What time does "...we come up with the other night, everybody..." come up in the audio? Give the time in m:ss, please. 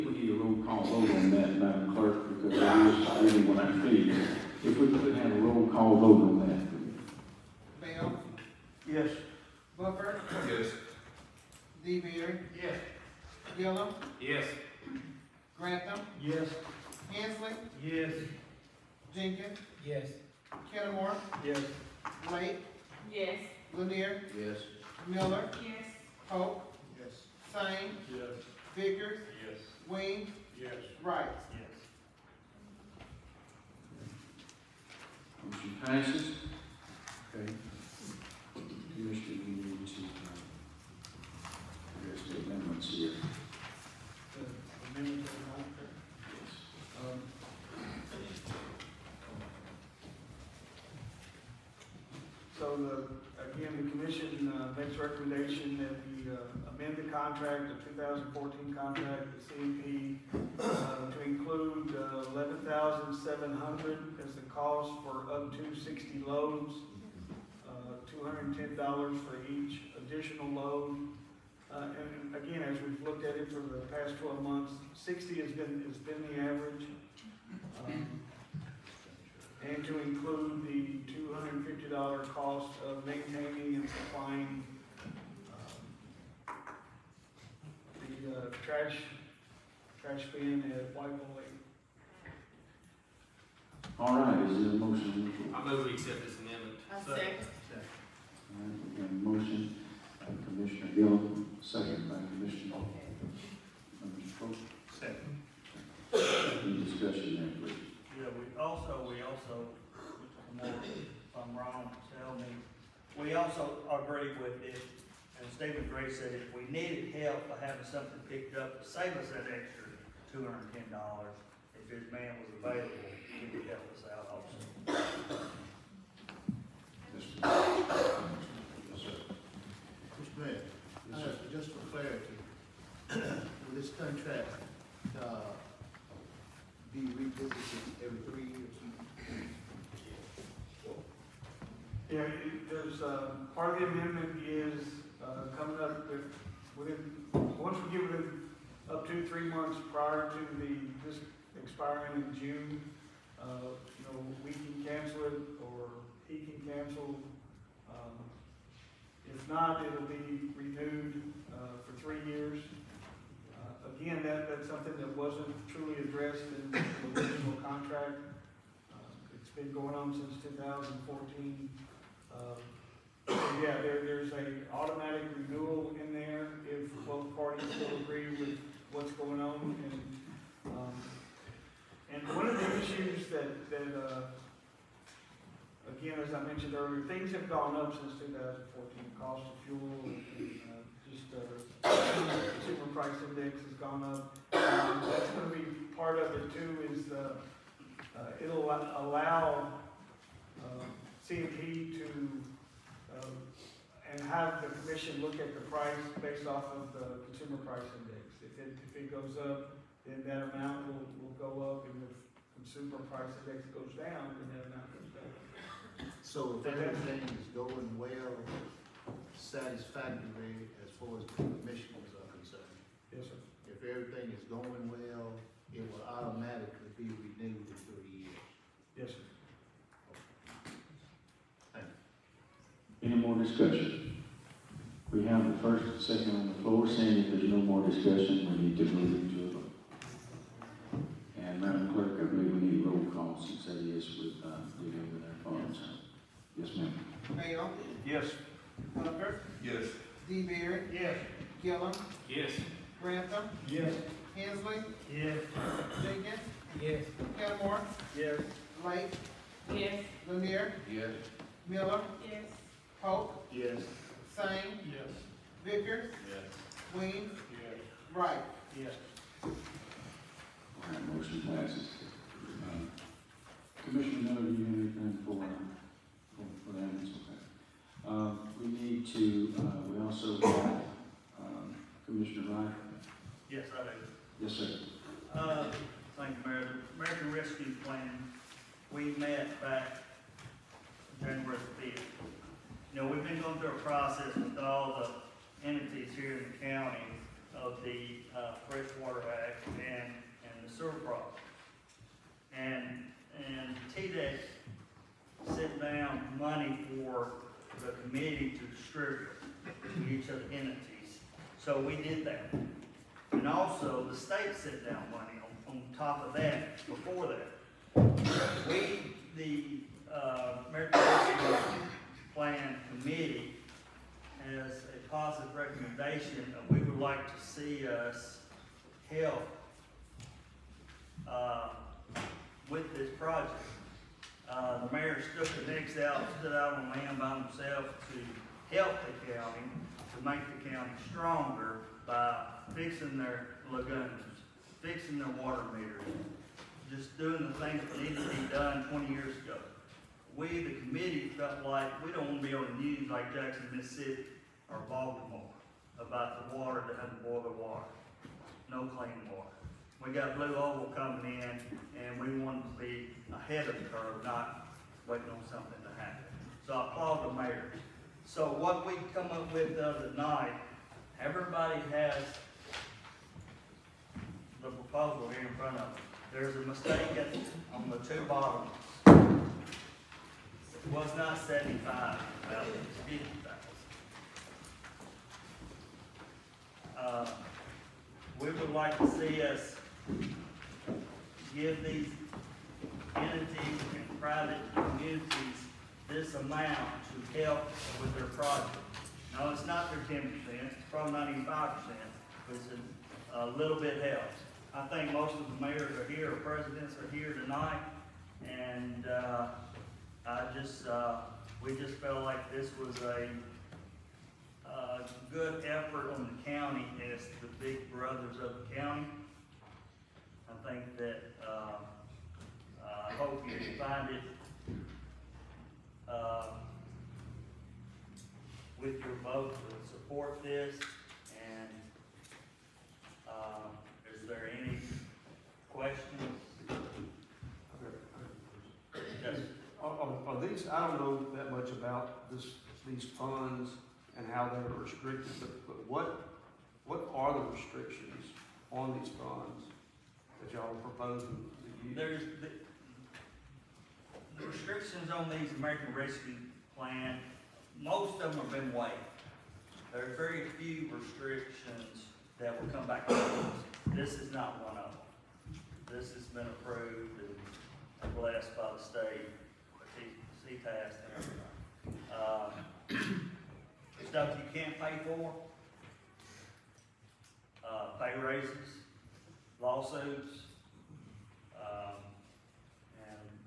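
6:08.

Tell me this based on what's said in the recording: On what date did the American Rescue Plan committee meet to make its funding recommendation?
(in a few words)
January 5th.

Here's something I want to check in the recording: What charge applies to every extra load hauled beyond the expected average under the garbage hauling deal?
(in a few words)
$210.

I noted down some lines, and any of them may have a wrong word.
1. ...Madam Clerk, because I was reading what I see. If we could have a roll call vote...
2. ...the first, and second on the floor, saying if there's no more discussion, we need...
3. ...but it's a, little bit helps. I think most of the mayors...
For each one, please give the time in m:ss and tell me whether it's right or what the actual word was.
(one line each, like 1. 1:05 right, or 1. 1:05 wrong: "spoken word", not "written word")
1. 0:01 right
2. 3:55 right
3. 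6:41 right.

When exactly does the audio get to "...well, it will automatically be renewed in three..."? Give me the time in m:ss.
3:44.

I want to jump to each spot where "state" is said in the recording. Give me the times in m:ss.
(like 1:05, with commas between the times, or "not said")
5:14, 7:48.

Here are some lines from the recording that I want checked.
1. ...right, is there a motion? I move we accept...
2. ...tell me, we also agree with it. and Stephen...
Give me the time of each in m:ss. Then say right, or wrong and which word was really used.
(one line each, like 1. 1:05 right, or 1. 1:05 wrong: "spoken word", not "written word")
1. 1:34 right
2. 1:52 right.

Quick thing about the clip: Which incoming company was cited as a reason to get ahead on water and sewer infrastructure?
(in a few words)
BlueOval.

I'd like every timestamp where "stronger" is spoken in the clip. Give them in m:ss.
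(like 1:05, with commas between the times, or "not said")
5:41.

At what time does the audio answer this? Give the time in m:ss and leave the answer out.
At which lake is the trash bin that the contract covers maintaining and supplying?
1:30.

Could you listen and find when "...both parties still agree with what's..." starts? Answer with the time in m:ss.
2:57.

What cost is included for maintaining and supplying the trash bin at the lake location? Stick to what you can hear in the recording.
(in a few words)
$250.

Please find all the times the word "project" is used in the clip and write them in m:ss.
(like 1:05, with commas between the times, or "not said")
5:33, 6:38.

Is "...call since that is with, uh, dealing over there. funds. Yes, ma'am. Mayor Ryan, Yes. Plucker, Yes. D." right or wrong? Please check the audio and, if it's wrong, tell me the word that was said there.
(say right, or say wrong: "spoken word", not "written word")
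wrong: "Oakley", not "Ryan".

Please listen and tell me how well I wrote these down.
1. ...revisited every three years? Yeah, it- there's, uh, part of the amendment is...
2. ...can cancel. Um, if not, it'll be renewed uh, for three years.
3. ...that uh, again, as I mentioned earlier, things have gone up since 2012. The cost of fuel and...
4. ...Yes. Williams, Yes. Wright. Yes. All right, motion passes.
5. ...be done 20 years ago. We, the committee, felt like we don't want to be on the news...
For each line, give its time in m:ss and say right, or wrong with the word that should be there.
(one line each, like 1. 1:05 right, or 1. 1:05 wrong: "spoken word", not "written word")
1. 2:16 right
2. 2:36 right
3. 3:03 wrong: "2014", not "2012"
4. 4:26 right
5. 5:48 right.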